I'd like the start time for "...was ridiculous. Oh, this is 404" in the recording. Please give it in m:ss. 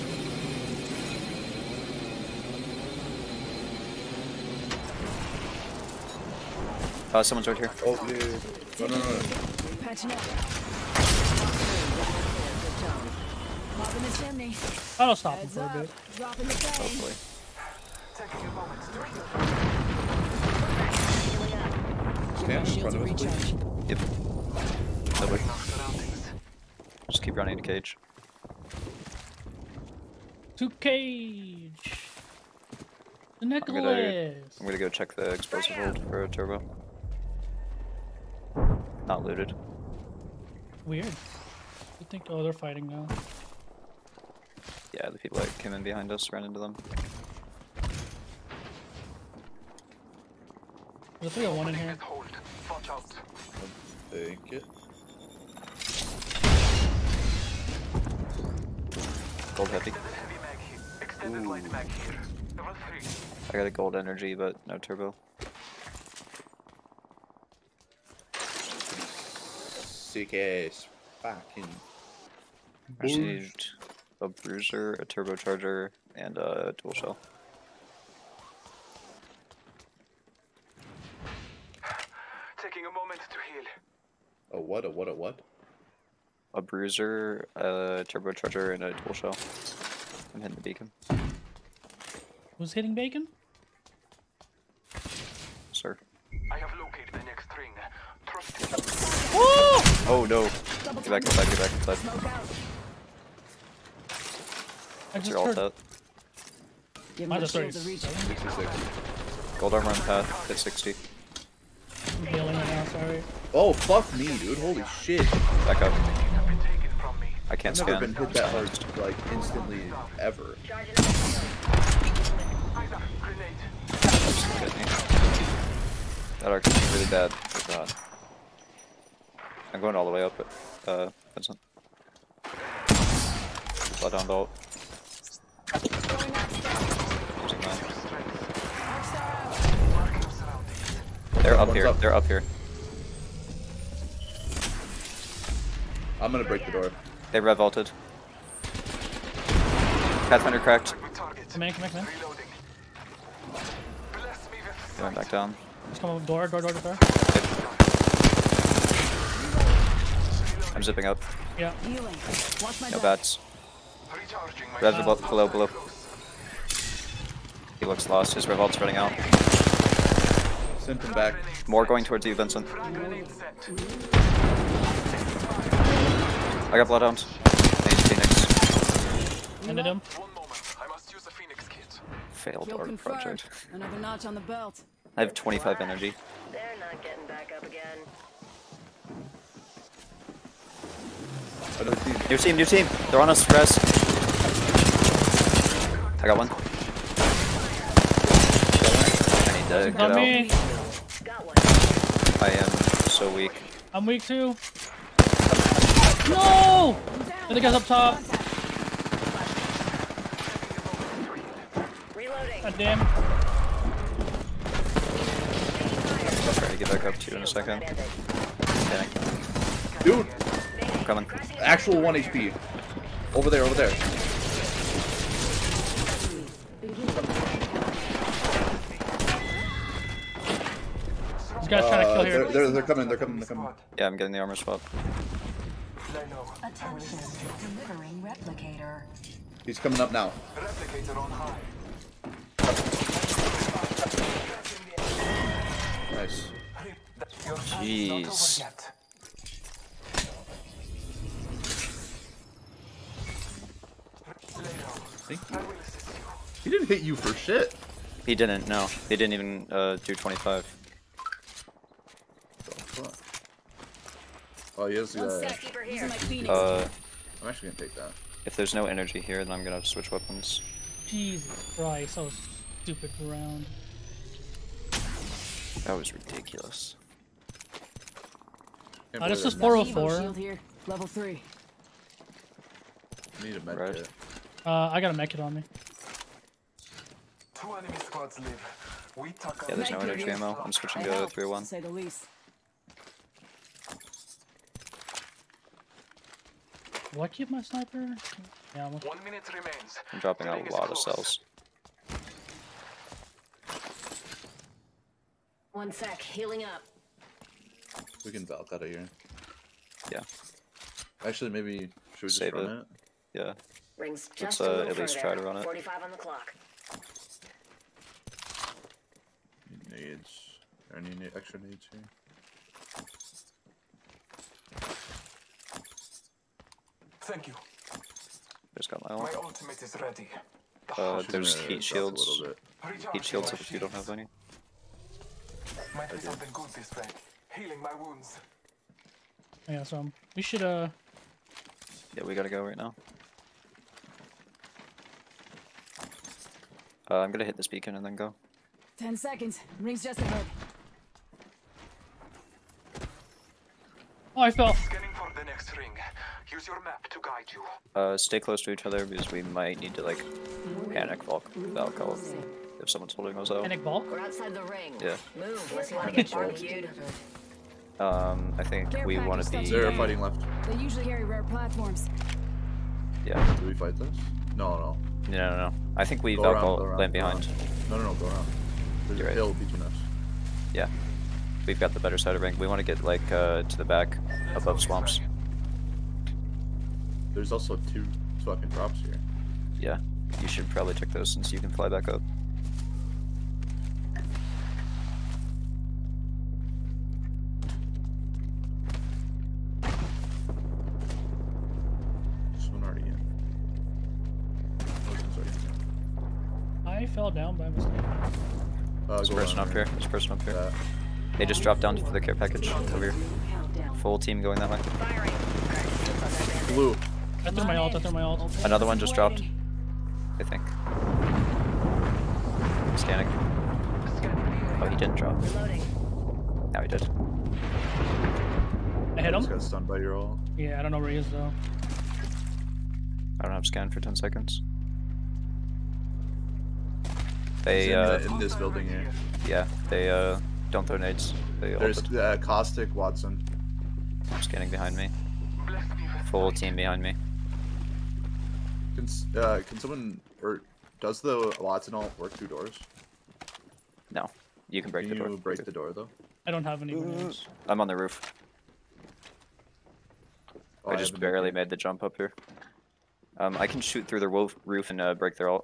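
4:35.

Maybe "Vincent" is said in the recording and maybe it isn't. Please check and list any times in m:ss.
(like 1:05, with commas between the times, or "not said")
2:11, 2:52.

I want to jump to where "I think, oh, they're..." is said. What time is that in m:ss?
0:41.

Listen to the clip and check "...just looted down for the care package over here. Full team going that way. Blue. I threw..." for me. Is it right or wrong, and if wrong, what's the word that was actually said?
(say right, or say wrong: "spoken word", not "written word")
wrong: "dropped", not "looted".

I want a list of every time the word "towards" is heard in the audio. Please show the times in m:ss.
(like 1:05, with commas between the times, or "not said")
2:52.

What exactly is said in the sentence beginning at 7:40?
Oh, I, I just barely made the jump up here.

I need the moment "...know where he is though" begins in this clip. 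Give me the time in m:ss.
7:10.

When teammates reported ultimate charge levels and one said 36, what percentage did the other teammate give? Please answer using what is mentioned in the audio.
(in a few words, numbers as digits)
66.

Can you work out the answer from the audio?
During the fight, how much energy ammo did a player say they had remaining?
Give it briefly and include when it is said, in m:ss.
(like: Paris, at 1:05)
25, at 3:05.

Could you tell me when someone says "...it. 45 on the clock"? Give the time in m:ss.
5:15.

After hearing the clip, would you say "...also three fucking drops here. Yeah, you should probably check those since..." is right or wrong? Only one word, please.
wrong.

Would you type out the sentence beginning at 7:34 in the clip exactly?
No, you can break can the door.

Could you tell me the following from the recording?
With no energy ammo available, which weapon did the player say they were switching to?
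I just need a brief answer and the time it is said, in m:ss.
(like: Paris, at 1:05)
301, at 4:50.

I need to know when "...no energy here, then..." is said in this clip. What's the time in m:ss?
4:28.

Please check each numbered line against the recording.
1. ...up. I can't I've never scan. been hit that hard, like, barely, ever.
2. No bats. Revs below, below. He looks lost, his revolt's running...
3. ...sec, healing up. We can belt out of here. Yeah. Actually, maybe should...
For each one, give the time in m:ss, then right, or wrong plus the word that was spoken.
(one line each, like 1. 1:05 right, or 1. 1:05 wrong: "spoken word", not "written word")
1. 1:55 wrong: "instantly", not "barely"
2. 2:42 right
3. 5:05 right.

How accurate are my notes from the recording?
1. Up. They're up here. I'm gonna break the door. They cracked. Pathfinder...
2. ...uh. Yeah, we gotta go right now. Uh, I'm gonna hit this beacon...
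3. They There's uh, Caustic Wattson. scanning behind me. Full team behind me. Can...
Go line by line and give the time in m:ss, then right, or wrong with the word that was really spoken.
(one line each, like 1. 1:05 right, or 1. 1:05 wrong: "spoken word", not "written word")
1. 2:21 wrong: "revolted", not "cracked"
2. 5:40 right
3. 7:21 right.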